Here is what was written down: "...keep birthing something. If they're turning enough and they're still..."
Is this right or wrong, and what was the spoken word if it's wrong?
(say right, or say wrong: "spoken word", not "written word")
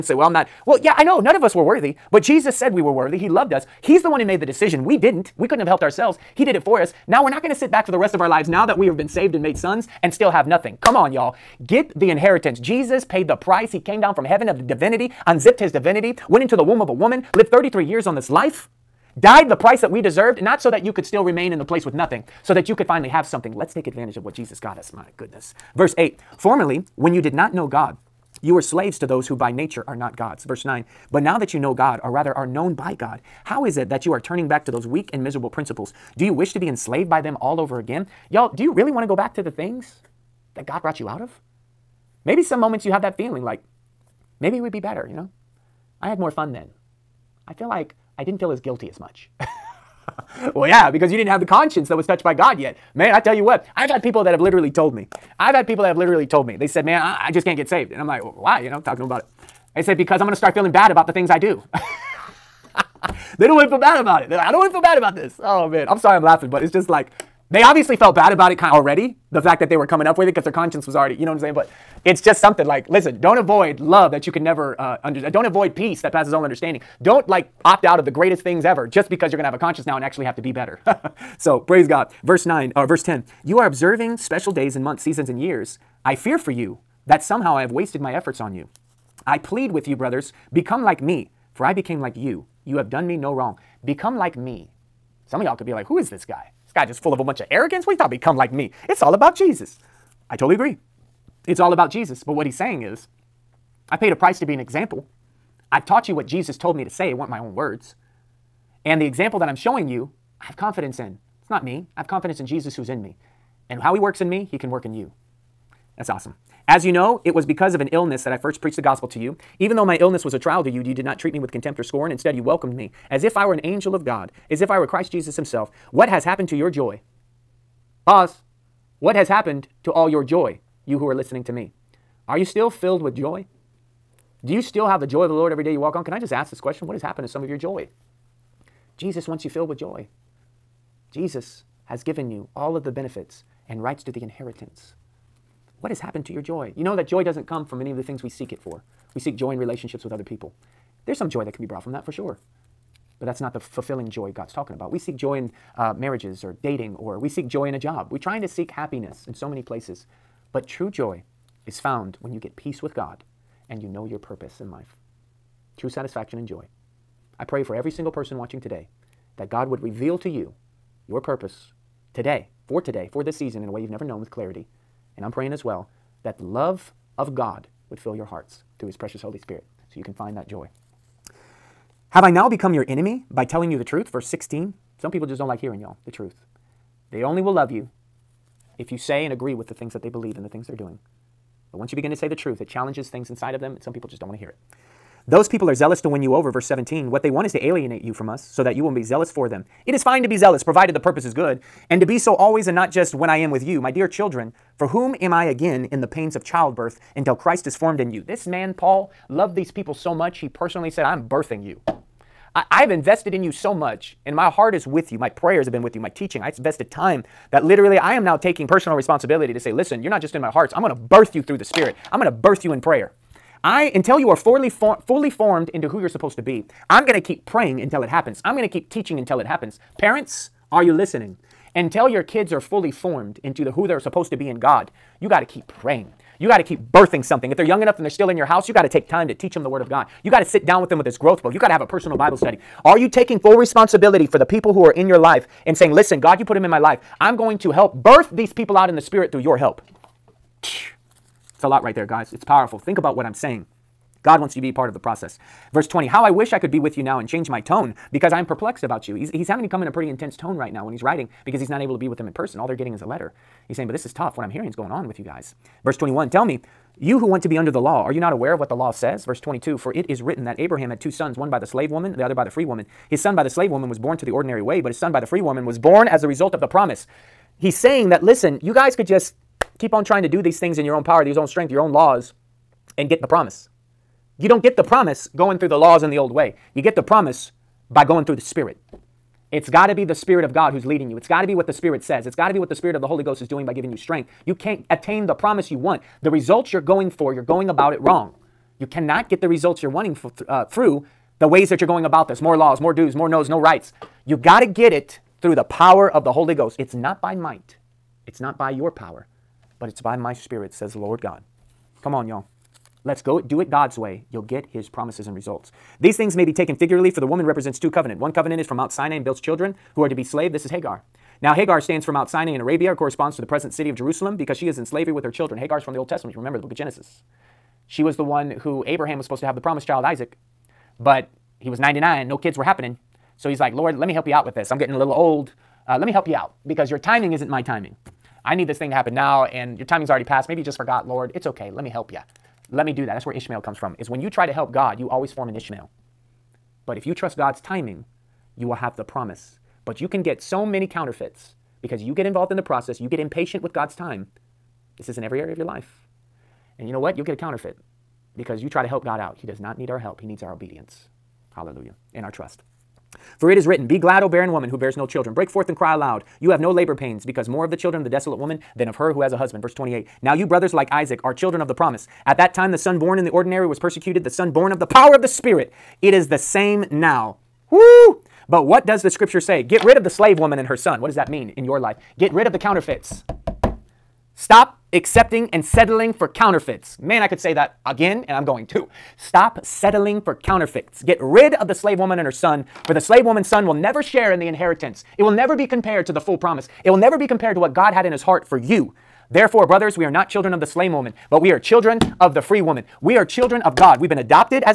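wrong: "young", not "turning".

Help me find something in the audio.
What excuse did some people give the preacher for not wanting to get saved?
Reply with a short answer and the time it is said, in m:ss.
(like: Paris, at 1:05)
Feeling bad, at 1:00.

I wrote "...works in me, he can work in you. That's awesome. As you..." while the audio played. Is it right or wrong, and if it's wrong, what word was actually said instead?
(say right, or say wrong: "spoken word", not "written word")
right.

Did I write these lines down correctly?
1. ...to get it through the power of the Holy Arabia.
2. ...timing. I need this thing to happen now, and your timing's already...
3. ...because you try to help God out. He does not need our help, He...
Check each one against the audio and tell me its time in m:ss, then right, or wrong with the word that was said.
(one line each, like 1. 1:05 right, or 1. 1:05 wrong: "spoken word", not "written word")
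1. 5:04 wrong: "Ghost", not "Arabia"
2. 5:37 right
3. 5:58 right.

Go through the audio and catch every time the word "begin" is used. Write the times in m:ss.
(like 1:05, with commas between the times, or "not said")
3:11.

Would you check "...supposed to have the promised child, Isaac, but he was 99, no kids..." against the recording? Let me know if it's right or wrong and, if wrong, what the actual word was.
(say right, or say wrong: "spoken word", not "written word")
right.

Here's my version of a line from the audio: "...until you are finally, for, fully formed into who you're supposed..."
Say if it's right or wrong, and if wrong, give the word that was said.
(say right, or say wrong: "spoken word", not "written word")
wrong: "fully", not "finally".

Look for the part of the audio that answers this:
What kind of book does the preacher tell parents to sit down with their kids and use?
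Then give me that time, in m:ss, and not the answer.
4:01.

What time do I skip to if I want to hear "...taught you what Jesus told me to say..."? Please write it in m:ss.
1:45.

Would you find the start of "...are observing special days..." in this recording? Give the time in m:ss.
1:23.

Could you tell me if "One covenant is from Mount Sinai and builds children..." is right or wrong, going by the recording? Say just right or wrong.
right.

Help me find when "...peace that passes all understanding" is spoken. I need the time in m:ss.
1:15.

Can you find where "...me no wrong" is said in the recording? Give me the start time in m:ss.
1:33.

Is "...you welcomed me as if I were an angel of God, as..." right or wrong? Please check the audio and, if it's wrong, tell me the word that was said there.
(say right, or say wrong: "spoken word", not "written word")
right.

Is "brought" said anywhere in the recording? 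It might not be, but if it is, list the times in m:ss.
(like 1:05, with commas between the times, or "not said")
0:40, 2:31.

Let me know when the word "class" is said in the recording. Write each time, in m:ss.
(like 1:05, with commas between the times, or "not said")
not said.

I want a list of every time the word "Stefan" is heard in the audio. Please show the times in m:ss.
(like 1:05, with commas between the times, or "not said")
not said.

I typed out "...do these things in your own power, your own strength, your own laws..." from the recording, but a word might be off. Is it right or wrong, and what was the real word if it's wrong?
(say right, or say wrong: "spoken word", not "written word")
right.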